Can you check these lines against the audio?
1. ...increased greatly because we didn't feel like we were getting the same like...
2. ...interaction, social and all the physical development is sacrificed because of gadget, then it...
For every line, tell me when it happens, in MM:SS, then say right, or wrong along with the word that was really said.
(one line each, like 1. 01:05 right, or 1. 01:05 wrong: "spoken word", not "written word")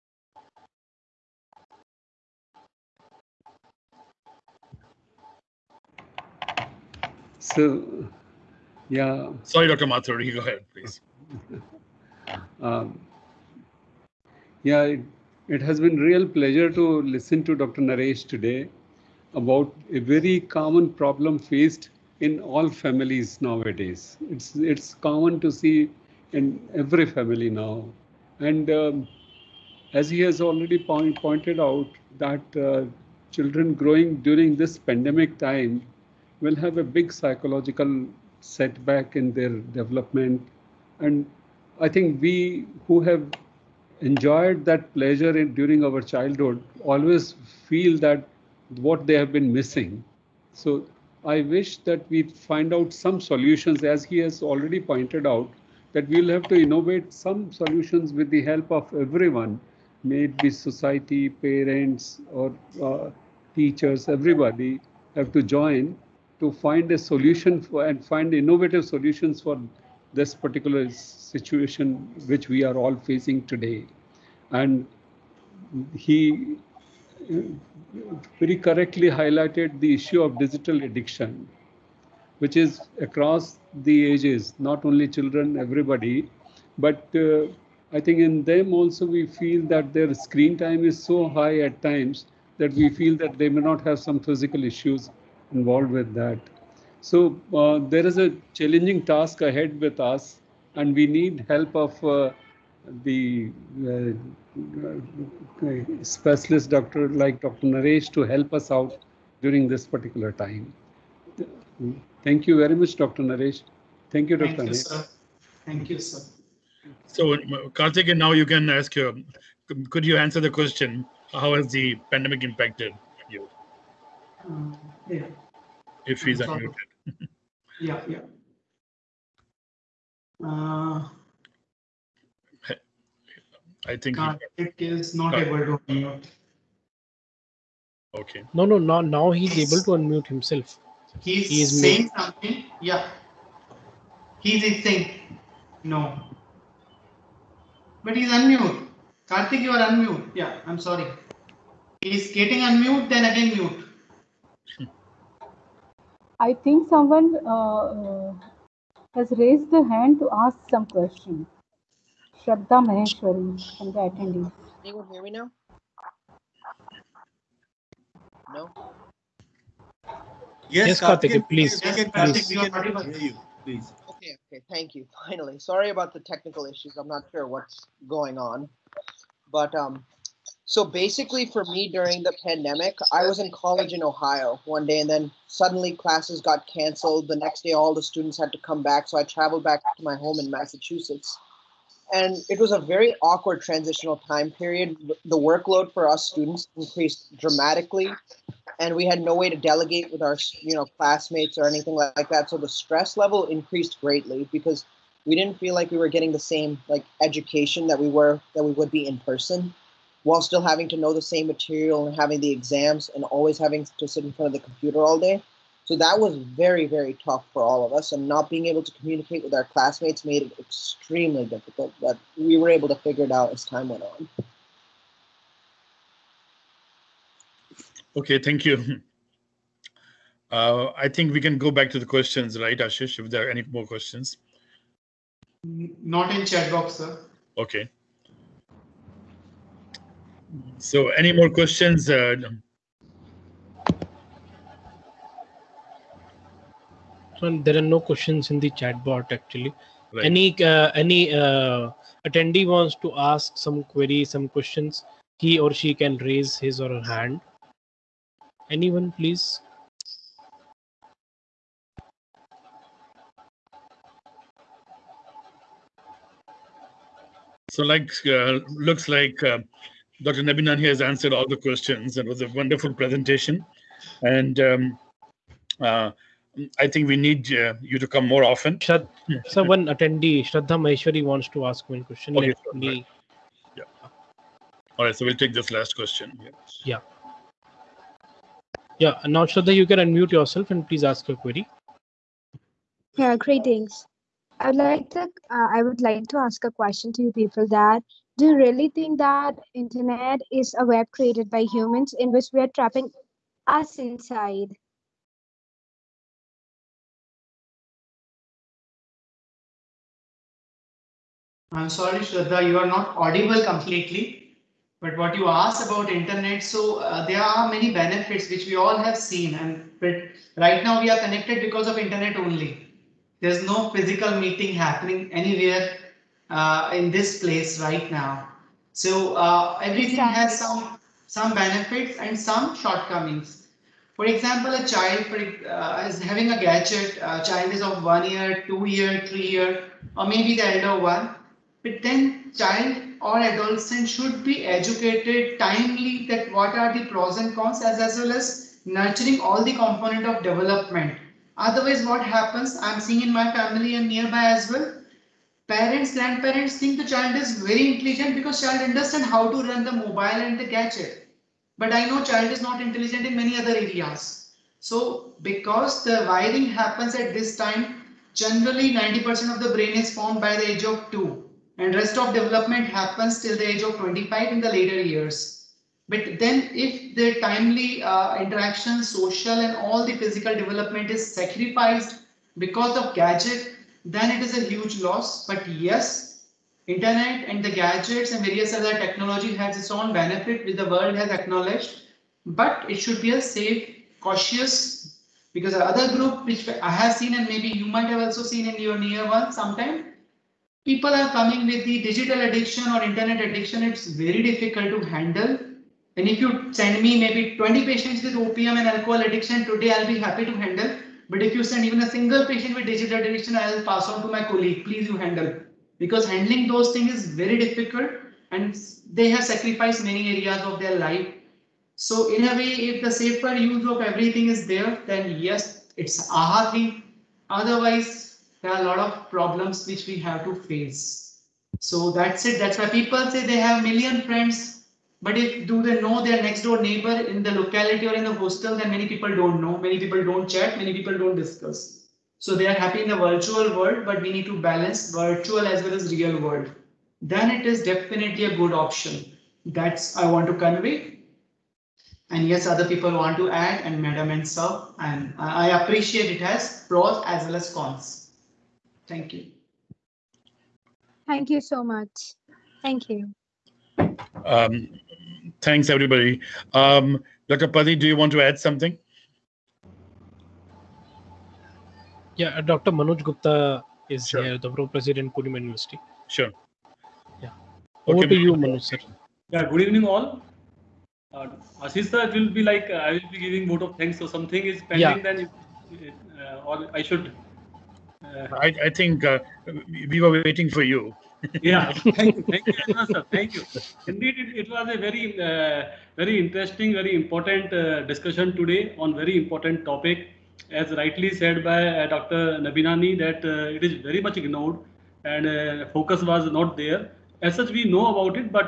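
1. 03:23 right
2. 06:18 right.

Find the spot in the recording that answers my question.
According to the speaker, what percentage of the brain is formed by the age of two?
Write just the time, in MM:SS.
06:08.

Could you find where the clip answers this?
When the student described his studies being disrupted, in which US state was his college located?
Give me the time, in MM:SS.
03:04.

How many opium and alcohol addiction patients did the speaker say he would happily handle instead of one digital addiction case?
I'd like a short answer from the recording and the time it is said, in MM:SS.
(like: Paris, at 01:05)
20, at 06:47.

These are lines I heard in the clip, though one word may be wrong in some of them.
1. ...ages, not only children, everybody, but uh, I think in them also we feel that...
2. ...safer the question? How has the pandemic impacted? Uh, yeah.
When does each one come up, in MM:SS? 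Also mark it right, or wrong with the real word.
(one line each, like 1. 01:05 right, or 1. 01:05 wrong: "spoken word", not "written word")
1. 01:24 right
2. 02:00 wrong: "answer", not "safer".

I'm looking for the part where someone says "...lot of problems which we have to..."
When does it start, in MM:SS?
07:08.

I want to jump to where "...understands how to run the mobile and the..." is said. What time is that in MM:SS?
05:58.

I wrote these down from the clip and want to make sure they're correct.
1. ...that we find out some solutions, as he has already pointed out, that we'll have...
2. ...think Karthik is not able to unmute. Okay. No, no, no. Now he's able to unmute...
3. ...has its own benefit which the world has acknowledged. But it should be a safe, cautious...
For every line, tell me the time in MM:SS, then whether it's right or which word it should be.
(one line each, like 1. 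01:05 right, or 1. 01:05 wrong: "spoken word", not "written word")
1. 00:51 right
2. 02:13 right
3. 06:29 right.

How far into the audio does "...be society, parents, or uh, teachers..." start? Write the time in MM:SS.
01:00.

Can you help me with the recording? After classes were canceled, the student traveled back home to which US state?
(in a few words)
Massachusetts.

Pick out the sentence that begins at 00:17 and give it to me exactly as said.
Naresh today about a very common problem faced in all families nowadays.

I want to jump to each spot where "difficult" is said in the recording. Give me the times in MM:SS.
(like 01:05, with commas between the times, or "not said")
03:41, 06:44, 06:57.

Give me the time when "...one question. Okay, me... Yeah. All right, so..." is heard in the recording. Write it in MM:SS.
04:41.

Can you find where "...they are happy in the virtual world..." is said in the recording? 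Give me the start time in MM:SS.
07:22.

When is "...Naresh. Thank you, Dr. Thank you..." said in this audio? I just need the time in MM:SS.
01:53.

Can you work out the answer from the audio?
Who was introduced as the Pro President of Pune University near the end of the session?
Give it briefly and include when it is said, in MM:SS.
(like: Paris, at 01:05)
Dr. Manoj Gupta, at 07:52.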